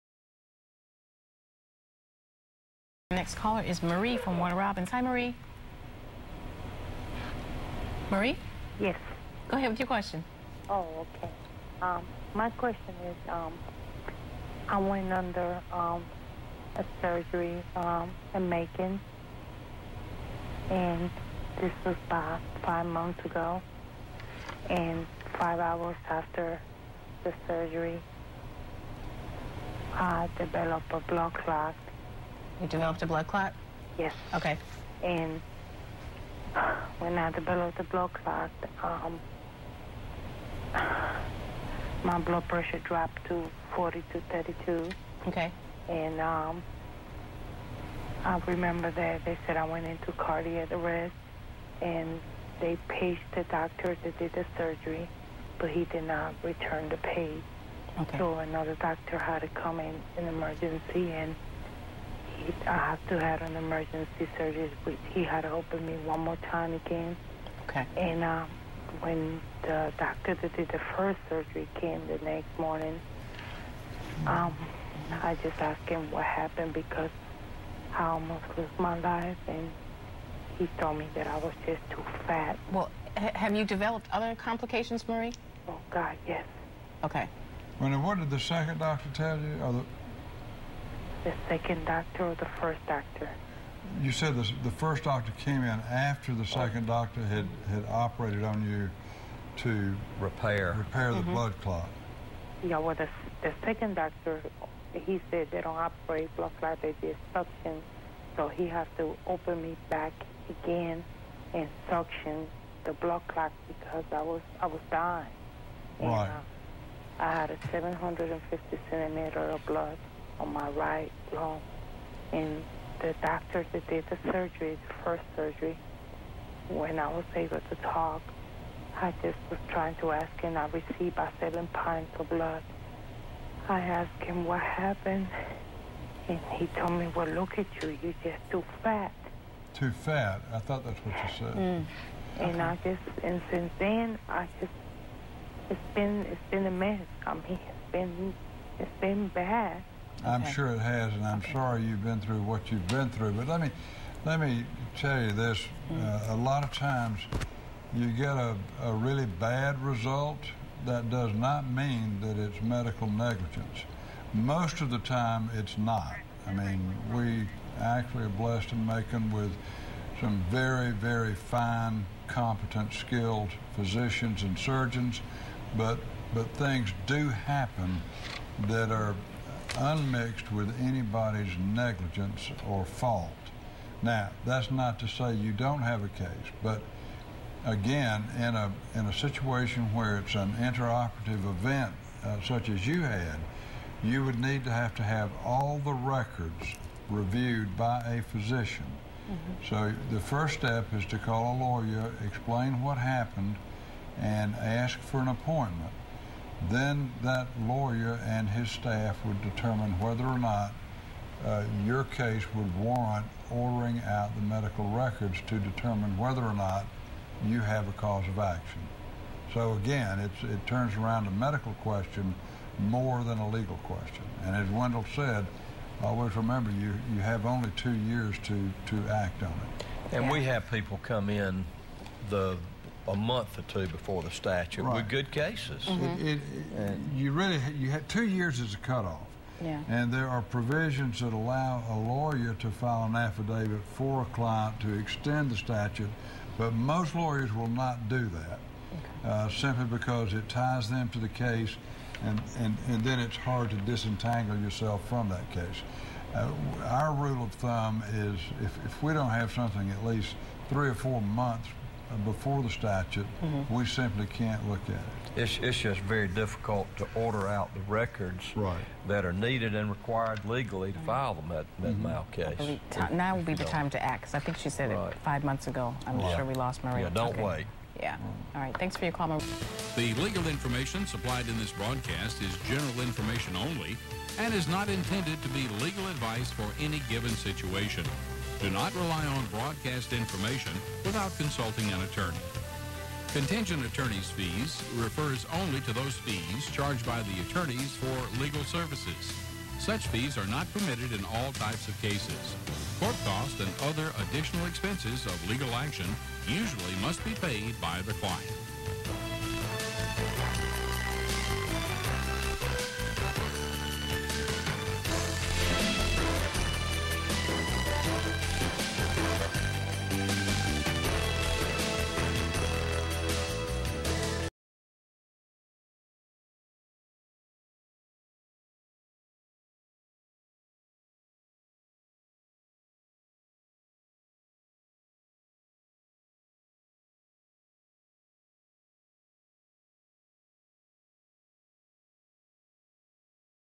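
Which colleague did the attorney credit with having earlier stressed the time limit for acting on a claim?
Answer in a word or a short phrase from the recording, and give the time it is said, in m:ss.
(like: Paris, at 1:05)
Wendell, at 3:44.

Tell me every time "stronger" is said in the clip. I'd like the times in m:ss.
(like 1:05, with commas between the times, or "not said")
not said.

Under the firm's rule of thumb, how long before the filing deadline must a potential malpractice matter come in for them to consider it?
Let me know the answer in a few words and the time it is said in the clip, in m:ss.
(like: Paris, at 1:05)
three or four months, at 4:20.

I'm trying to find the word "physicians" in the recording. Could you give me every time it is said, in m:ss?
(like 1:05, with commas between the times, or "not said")
2:53, 3:18.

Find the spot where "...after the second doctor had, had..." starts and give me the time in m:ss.
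1:35.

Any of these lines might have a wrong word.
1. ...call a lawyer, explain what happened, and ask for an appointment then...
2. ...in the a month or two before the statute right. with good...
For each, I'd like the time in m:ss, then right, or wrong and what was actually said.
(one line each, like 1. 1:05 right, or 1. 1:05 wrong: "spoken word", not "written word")
1. 3:21 right
2. 3:51 right.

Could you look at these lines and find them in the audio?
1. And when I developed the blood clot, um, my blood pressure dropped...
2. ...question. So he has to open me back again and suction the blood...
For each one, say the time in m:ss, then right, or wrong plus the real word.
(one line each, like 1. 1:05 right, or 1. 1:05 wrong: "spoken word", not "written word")
1. 0:35 right
2. 1:47 wrong: "suction", not "question".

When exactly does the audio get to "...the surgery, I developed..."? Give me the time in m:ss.
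0:27.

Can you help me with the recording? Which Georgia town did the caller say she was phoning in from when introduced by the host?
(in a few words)
Warner Robins.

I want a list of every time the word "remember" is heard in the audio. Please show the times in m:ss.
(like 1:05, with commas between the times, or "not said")
0:48, 3:46.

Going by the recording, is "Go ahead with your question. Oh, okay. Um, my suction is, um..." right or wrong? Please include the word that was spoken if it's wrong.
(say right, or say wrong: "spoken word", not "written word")
wrong: "question", not "suction".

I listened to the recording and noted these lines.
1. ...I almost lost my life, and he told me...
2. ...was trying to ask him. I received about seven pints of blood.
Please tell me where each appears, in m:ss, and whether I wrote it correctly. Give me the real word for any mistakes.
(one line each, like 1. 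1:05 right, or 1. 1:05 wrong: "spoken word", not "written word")
1. 1:17 right
2. 2:09 right.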